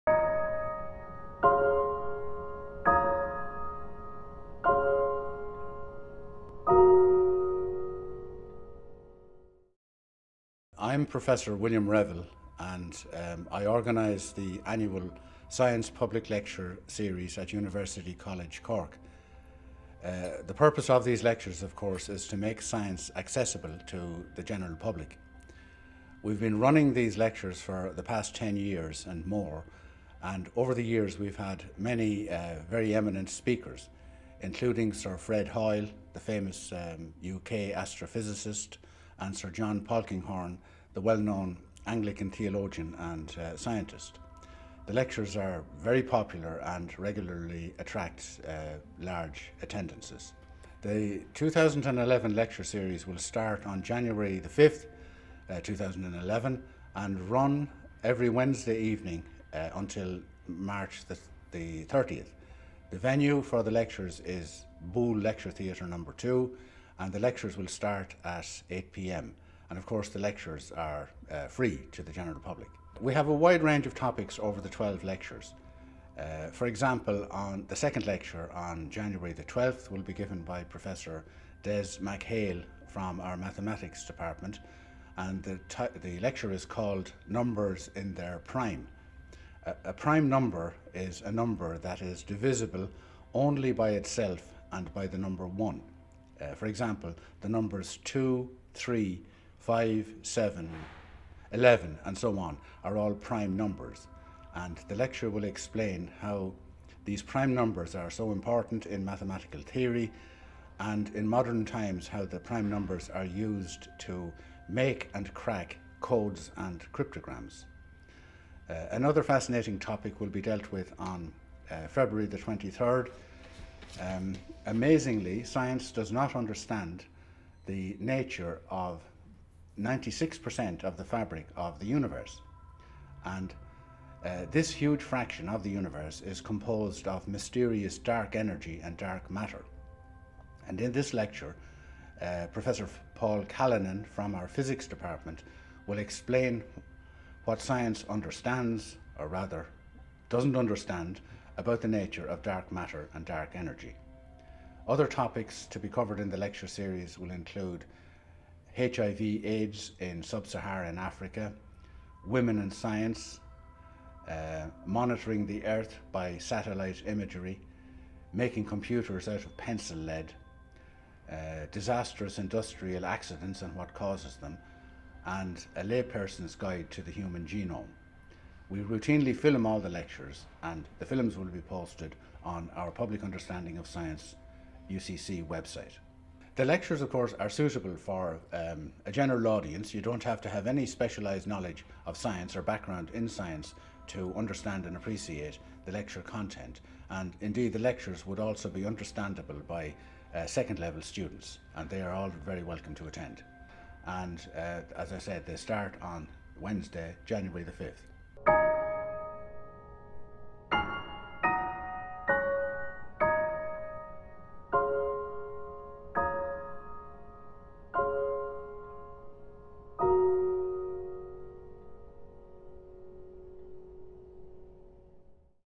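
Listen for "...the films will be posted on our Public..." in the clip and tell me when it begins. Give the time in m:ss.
3:00.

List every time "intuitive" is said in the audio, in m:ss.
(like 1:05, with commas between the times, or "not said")
not said.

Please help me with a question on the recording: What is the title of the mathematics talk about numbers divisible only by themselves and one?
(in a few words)
Numbers in Their Prime.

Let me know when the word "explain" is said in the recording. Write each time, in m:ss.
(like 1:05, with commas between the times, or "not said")
1:45, 2:25.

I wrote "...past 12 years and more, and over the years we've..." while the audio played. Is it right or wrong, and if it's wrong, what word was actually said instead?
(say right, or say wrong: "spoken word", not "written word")
wrong: "10", not "12".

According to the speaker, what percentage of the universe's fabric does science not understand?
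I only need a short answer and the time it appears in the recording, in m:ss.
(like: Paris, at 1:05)
96%, at 2:09.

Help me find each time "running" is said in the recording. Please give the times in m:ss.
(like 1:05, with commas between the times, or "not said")
0:26.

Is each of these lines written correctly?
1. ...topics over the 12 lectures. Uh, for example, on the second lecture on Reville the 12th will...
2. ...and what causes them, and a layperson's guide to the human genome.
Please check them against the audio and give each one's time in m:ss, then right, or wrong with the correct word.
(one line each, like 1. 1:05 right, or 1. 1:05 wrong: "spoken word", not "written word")
1. 1:13 wrong: "January", not "Reville"
2. 2:53 right.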